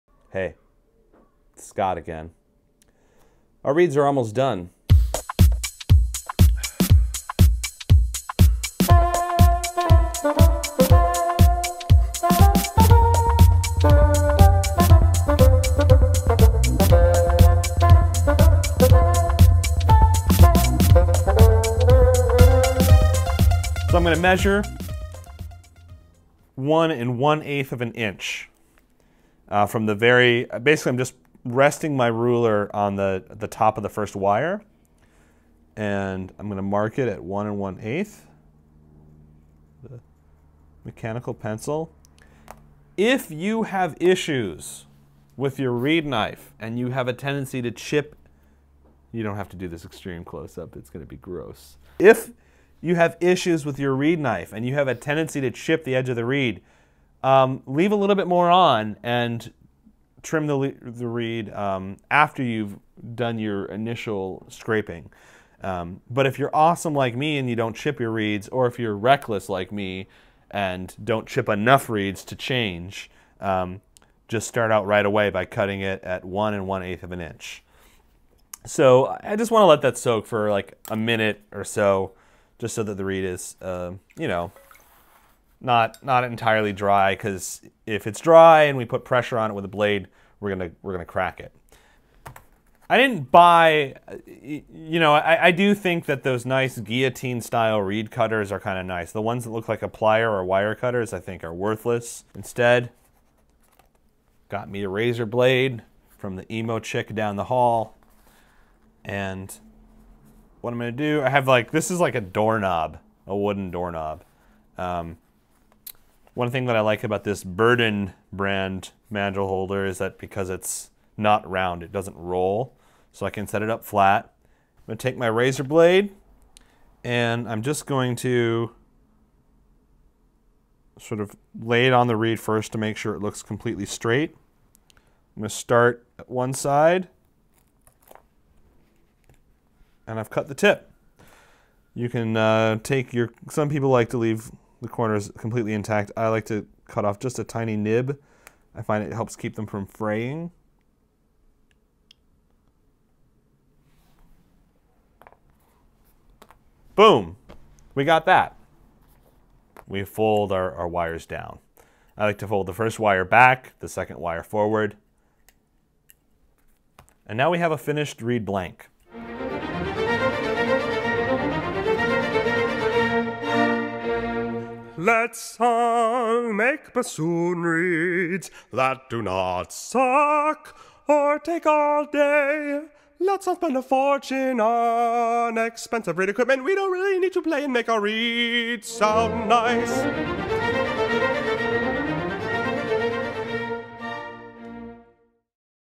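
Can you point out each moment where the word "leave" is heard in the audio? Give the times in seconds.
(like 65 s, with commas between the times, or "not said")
57 s, 144 s.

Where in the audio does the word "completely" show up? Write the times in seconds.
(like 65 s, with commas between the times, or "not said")
133 s, 145 s.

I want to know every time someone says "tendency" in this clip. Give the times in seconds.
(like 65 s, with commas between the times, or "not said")
47 s, 54 s.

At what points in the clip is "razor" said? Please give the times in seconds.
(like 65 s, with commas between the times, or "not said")
104 s, 125 s.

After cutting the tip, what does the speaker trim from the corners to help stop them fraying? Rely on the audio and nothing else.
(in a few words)
A tiny nib.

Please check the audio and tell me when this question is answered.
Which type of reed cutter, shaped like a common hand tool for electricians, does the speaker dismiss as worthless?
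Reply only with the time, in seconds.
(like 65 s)
100 s.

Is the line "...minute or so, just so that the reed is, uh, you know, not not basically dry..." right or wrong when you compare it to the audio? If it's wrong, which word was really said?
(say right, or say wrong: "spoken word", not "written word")
wrong: "entirely", not "basically".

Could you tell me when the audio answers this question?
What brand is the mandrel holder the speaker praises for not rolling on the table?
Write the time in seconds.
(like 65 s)
117 s.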